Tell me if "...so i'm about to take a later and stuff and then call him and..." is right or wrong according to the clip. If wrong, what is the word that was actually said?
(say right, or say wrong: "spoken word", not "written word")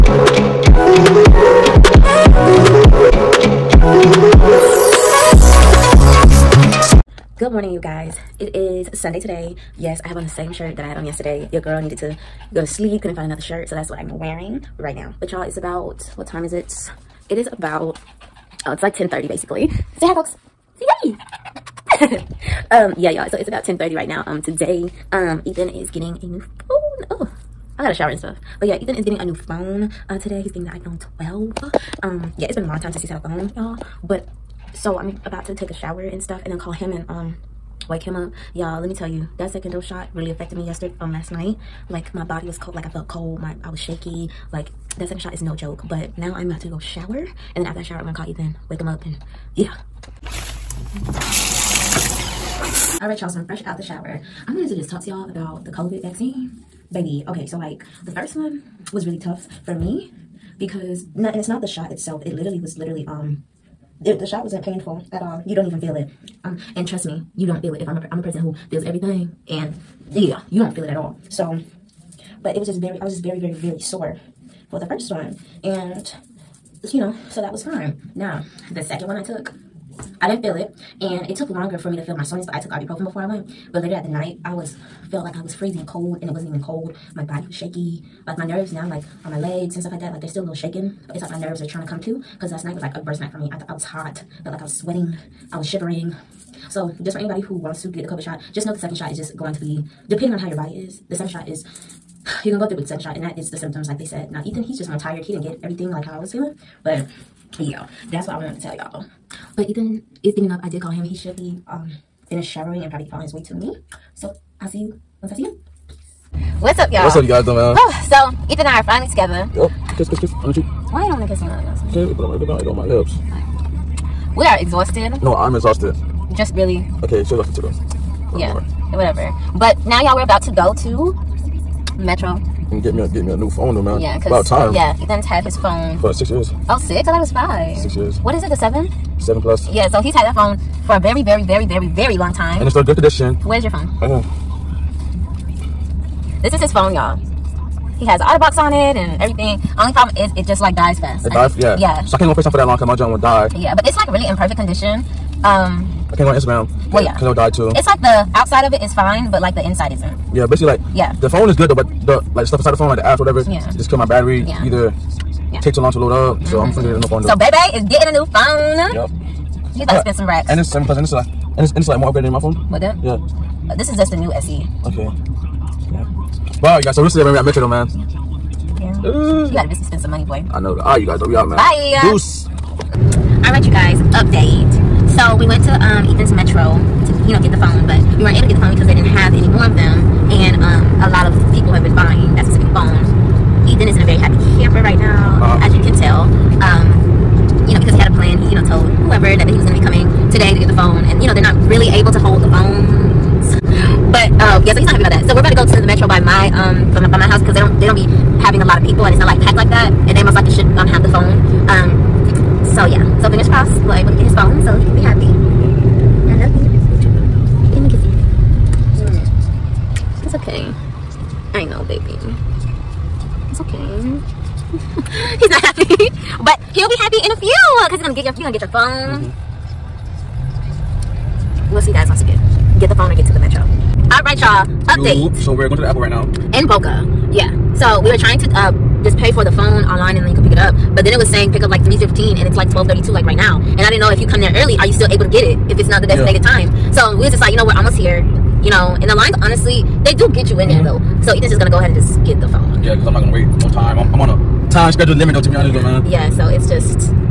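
wrong: "shower", not "later".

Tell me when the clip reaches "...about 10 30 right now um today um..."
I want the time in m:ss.
0:23.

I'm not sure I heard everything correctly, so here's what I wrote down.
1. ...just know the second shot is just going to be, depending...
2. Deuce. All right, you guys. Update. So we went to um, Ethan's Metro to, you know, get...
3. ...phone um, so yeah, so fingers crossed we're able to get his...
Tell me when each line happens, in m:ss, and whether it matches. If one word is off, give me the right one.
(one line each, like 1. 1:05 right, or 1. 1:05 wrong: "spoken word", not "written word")
1. 1:38 right
2. 3:02 right
3. 3:31 right.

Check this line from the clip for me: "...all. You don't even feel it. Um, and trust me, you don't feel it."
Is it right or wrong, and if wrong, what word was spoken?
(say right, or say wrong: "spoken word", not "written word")
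right.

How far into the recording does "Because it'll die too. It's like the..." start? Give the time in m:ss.
2:37.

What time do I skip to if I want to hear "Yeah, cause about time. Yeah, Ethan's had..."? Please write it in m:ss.
2:13.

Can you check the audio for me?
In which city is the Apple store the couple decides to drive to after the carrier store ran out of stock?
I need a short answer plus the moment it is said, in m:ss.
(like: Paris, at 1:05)
Boca, at 3:56.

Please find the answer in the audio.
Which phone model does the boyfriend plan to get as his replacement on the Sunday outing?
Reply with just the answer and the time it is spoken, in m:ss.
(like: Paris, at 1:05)
iPhone 12, at 0:30.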